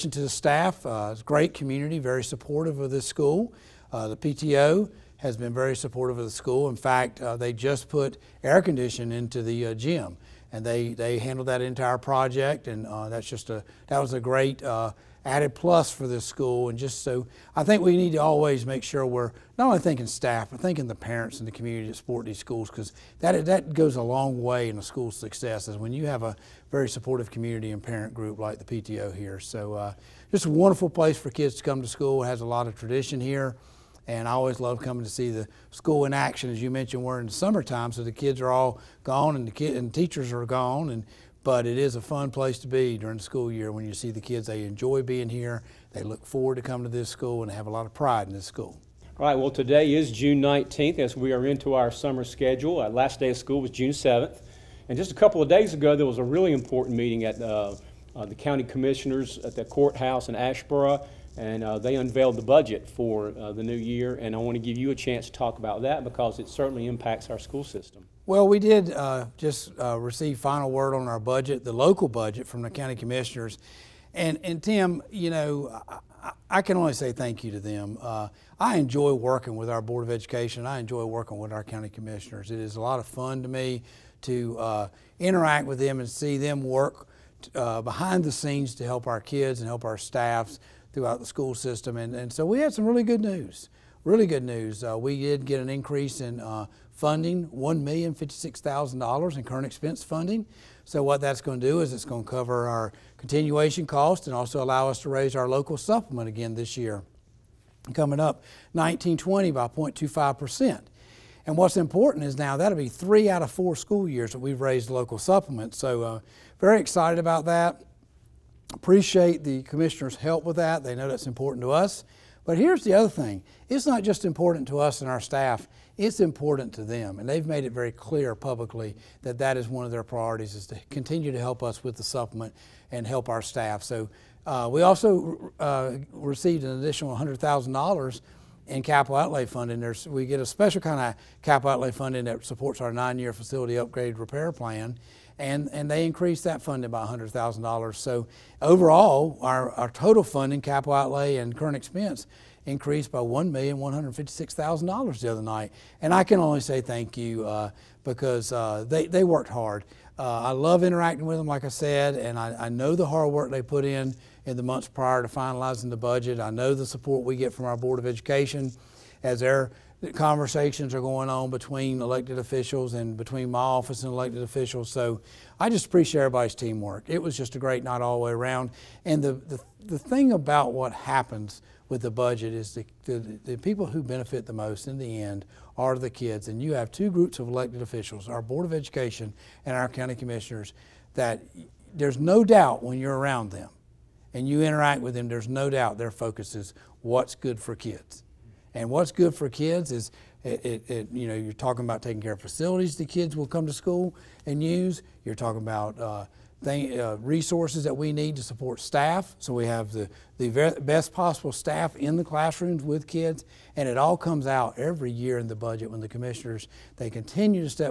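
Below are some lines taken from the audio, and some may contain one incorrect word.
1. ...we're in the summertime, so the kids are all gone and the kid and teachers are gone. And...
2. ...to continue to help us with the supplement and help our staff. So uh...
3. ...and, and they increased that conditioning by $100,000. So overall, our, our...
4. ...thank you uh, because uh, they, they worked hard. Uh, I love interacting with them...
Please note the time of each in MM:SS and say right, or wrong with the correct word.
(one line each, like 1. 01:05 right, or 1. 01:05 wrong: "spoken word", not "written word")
1. 00:37 right
2. 02:10 right
3. 02:25 wrong: "funding", not "conditioning"
4. 02:36 right.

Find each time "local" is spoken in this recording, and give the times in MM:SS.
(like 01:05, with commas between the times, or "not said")
01:11, 01:45, 01:54.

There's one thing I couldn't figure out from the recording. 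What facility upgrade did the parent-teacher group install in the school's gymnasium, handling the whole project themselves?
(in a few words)
air conditioning.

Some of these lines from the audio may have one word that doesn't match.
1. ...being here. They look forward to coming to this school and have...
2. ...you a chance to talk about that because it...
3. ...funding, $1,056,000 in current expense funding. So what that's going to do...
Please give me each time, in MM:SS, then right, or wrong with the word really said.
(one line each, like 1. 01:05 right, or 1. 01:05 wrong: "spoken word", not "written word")
1. 00:45 right
2. 01:04 right
3. 01:36 right.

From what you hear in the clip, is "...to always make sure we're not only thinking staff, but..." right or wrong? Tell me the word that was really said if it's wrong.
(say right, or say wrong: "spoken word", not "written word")
right.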